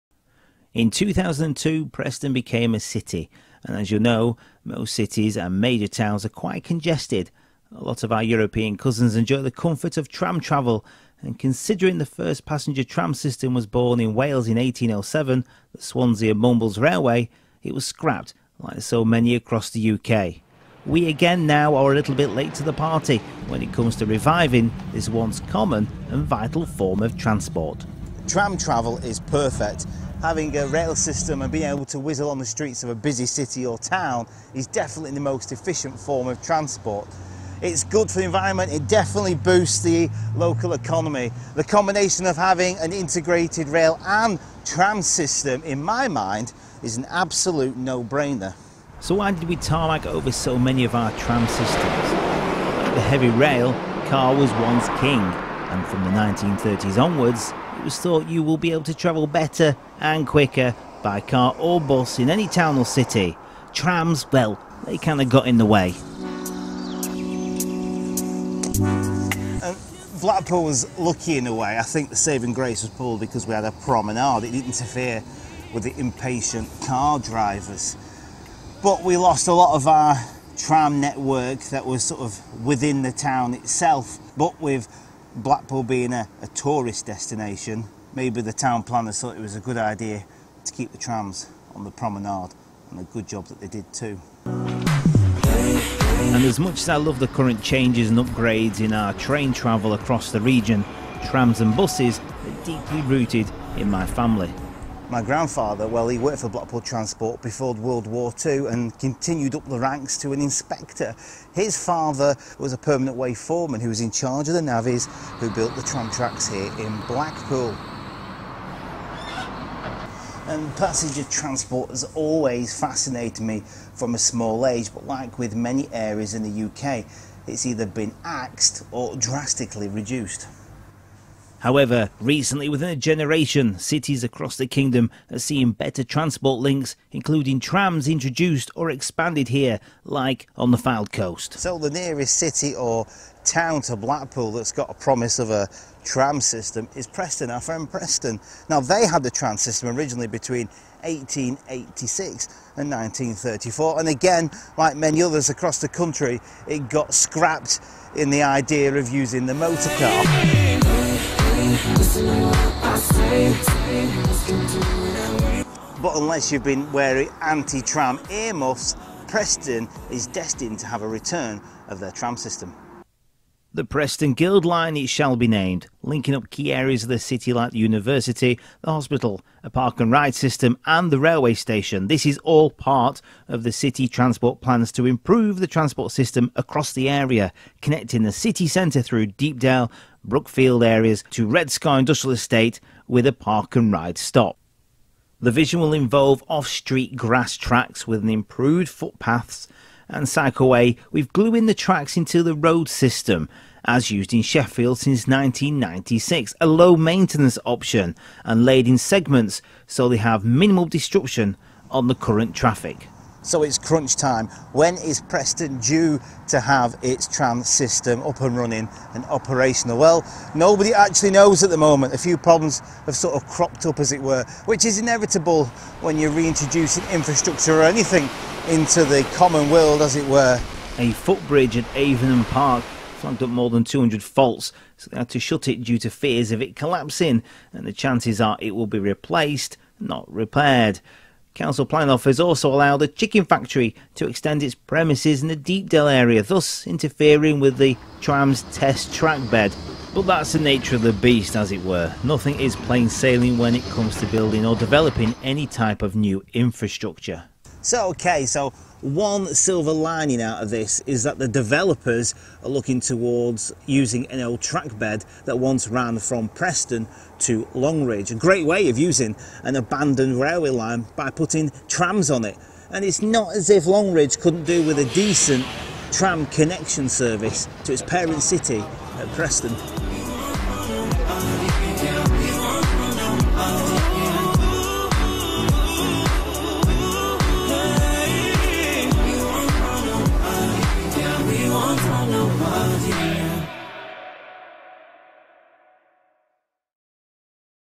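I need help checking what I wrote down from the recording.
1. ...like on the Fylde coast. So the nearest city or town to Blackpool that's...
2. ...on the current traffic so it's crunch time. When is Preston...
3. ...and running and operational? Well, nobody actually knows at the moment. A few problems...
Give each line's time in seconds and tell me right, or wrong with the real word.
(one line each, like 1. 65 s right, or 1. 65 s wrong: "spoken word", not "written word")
1. 140 s right
2. 211 s right
3. 218 s right.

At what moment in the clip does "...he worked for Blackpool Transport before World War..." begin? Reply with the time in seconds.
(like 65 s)
106 s.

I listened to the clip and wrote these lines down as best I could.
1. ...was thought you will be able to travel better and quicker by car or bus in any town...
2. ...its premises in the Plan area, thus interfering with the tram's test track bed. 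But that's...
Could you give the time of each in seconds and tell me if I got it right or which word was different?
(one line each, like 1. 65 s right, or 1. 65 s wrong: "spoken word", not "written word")
1. 57 s right
2. 244 s wrong: "Deepdale", not "Plan".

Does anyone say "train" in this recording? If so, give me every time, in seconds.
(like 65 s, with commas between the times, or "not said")
99 s.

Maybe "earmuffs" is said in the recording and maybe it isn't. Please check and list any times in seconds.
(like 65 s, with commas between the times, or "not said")
168 s.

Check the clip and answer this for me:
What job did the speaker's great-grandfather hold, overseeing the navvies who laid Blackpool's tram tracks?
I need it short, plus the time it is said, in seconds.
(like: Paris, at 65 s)
Permanent way foreman, at 112 s.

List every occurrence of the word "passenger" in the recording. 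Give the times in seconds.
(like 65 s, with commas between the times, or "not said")
12 s, 120 s.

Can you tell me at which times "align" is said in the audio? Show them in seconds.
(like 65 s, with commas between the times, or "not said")
not said.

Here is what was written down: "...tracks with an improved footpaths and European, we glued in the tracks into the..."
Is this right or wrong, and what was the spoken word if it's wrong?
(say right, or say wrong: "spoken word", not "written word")
wrong: "Cycleway", not "European".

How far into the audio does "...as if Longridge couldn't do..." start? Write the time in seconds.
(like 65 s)
273 s.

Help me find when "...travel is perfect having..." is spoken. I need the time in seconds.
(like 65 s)
28 s.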